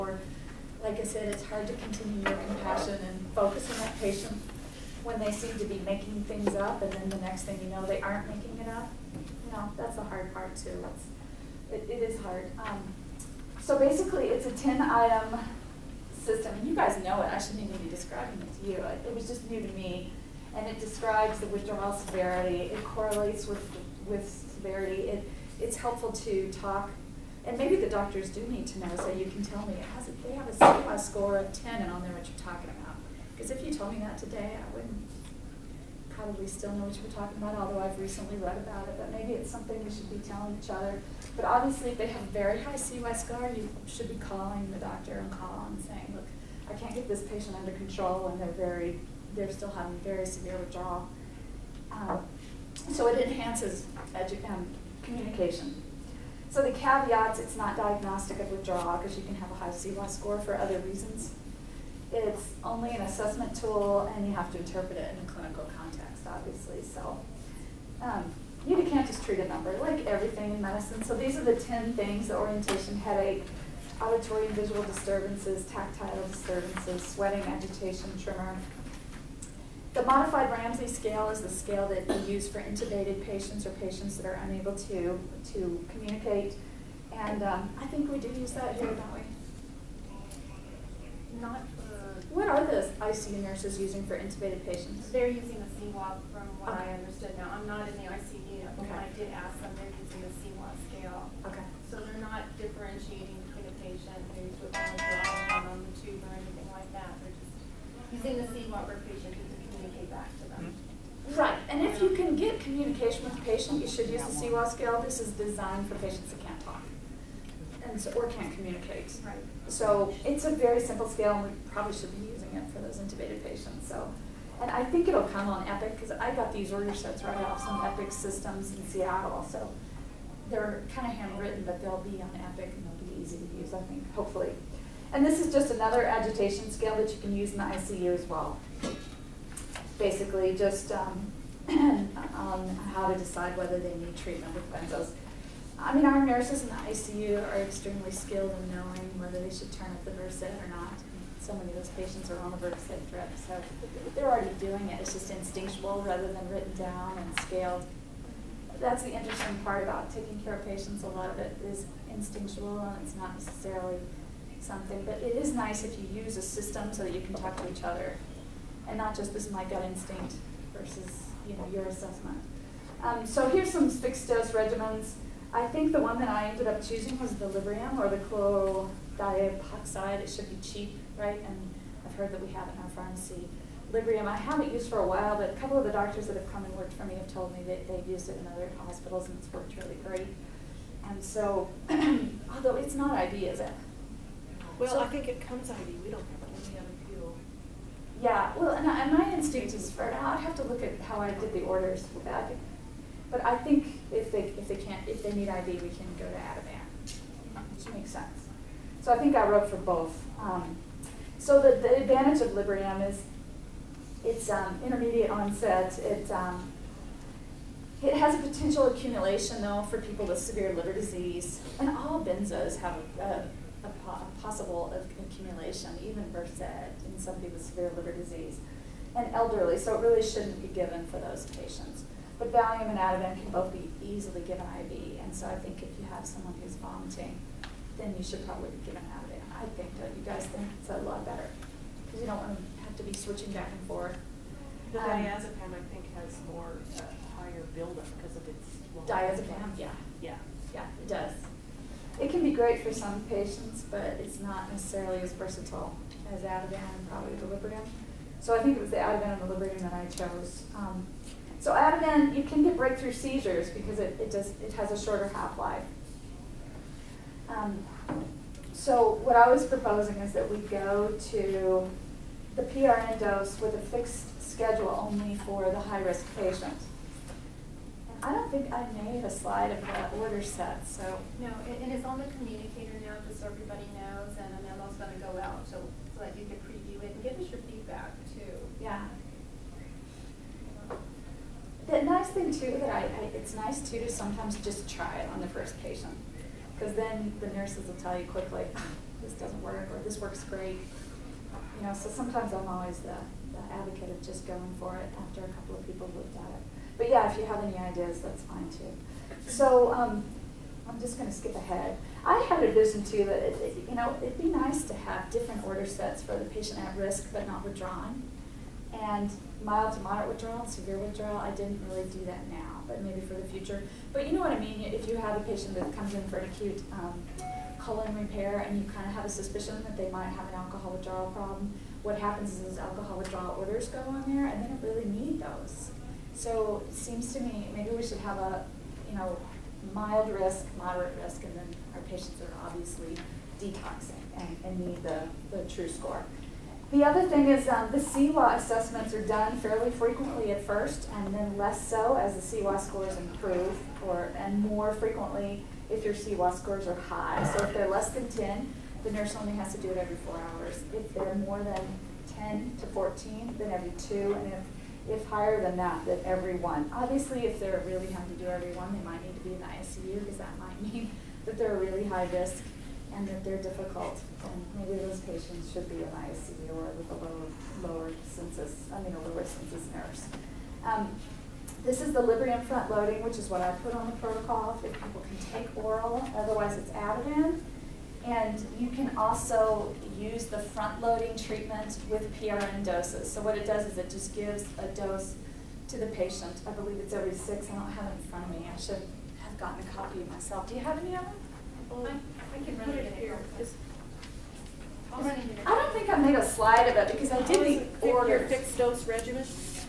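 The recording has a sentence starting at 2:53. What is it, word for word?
Um, so here's some fixed dose regimens.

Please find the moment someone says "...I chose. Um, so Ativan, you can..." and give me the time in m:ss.
4:19.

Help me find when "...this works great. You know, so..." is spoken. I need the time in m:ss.
5:00.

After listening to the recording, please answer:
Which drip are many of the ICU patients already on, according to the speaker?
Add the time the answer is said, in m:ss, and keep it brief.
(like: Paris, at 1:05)
Precedex, at 2:32.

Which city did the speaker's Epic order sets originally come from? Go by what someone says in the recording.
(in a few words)
Seattle.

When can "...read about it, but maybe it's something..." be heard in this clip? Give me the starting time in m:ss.
0:38.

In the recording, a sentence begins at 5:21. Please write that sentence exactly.
I didn't really do that now but maybe for the future.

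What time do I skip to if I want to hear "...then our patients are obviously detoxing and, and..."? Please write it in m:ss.
5:41.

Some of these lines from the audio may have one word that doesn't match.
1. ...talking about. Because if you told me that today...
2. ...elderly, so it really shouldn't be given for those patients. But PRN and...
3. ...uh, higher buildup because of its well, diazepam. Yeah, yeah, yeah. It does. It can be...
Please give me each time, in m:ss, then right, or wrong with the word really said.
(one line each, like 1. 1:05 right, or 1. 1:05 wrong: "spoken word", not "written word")
1. 0:32 right
2. 3:49 wrong: "Valium", not "PRN"
3. 4:06 right.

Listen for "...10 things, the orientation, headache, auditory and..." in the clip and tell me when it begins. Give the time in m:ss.
1:11.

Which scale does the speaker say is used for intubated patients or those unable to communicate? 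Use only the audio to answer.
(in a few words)
modified Ramsay scale.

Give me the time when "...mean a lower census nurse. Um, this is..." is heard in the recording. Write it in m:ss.
6:19.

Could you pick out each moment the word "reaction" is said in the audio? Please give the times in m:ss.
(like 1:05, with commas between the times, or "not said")
not said.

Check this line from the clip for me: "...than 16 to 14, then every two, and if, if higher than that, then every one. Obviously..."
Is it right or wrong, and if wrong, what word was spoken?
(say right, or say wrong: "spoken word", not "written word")
wrong: "10", not "16".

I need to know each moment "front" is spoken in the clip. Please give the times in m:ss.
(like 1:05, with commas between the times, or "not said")
6:22, 6:30, 6:38.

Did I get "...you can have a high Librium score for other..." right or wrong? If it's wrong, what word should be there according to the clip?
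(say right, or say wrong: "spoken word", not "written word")
wrong: "CIWA", not "Librium".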